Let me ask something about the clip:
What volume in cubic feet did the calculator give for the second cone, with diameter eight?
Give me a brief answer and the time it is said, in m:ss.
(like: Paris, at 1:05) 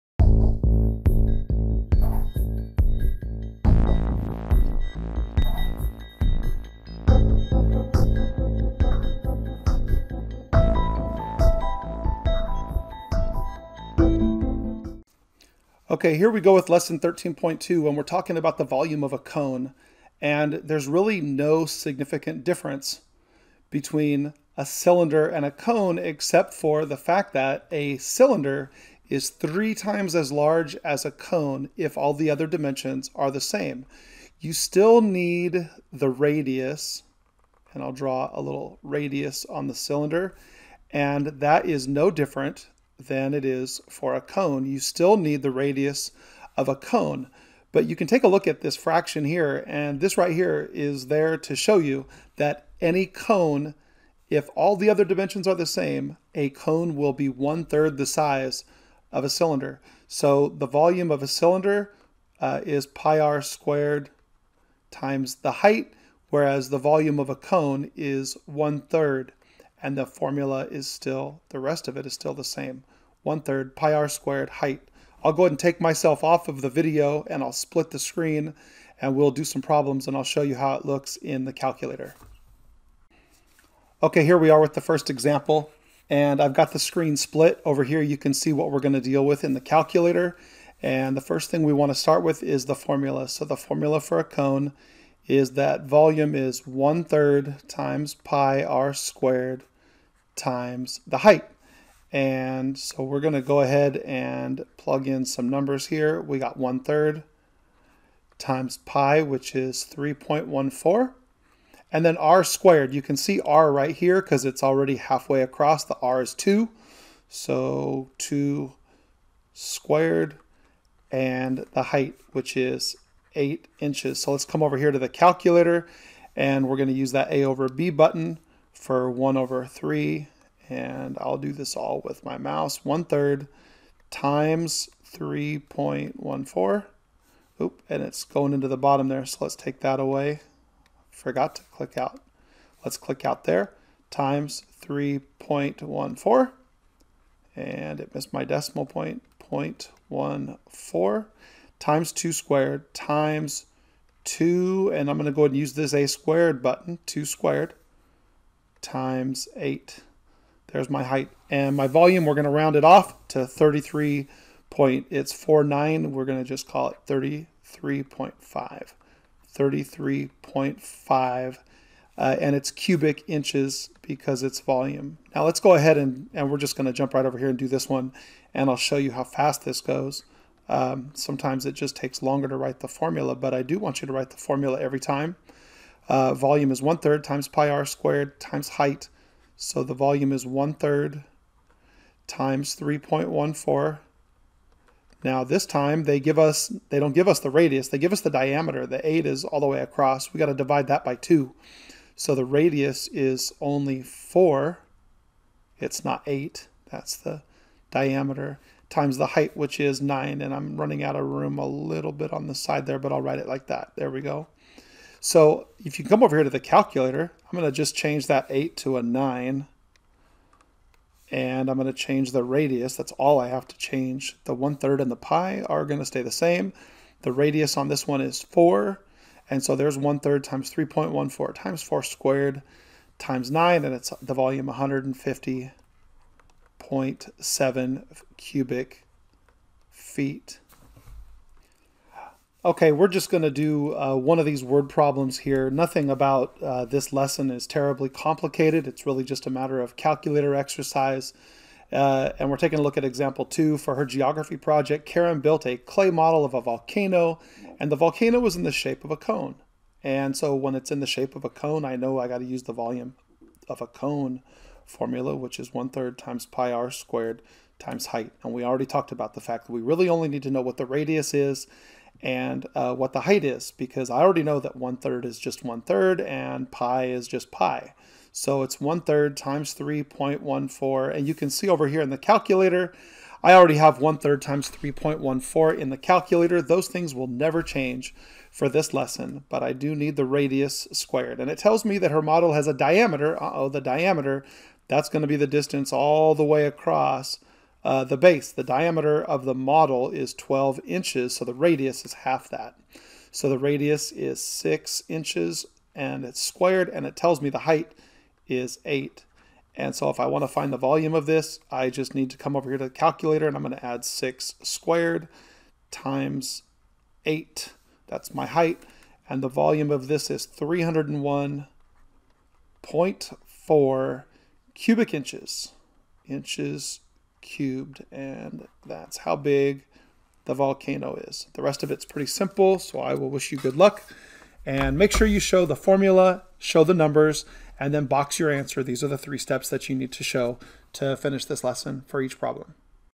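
150.7, at 3:54.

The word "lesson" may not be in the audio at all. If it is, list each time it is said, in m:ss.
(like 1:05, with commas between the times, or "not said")
0:16, 4:07, 4:48, 5:41.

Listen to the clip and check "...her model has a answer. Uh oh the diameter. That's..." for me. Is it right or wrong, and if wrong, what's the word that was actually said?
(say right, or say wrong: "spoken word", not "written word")
wrong: "diameter", not "answer".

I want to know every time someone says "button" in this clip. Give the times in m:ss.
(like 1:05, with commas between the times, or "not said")
2:07, 2:36.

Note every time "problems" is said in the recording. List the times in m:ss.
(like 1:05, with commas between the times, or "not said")
1:19, 4:04, 5:42.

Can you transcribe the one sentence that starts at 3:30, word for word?
And I'm running out of room a little bit on the side there, but I'll write it like that.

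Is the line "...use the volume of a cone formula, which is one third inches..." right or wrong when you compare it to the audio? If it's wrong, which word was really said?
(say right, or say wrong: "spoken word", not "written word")
wrong: "times", not "inches".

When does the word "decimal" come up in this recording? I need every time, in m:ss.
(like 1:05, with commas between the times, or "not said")
2:28.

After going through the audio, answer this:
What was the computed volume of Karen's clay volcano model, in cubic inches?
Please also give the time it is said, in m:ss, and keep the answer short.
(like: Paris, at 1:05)
301.4, at 5:20.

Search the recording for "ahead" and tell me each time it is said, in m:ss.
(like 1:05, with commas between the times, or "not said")
1:15, 1:43, 2:35, 2:55.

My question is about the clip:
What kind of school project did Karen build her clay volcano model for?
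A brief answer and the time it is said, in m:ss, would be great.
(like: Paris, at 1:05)
geography project, at 4:14.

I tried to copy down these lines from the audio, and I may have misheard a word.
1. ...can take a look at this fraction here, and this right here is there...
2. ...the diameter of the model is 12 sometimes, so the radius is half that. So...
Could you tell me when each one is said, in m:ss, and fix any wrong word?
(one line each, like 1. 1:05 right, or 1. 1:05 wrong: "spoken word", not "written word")
1. 0:47 right
2. 4:58 wrong: "inches", not "sometimes".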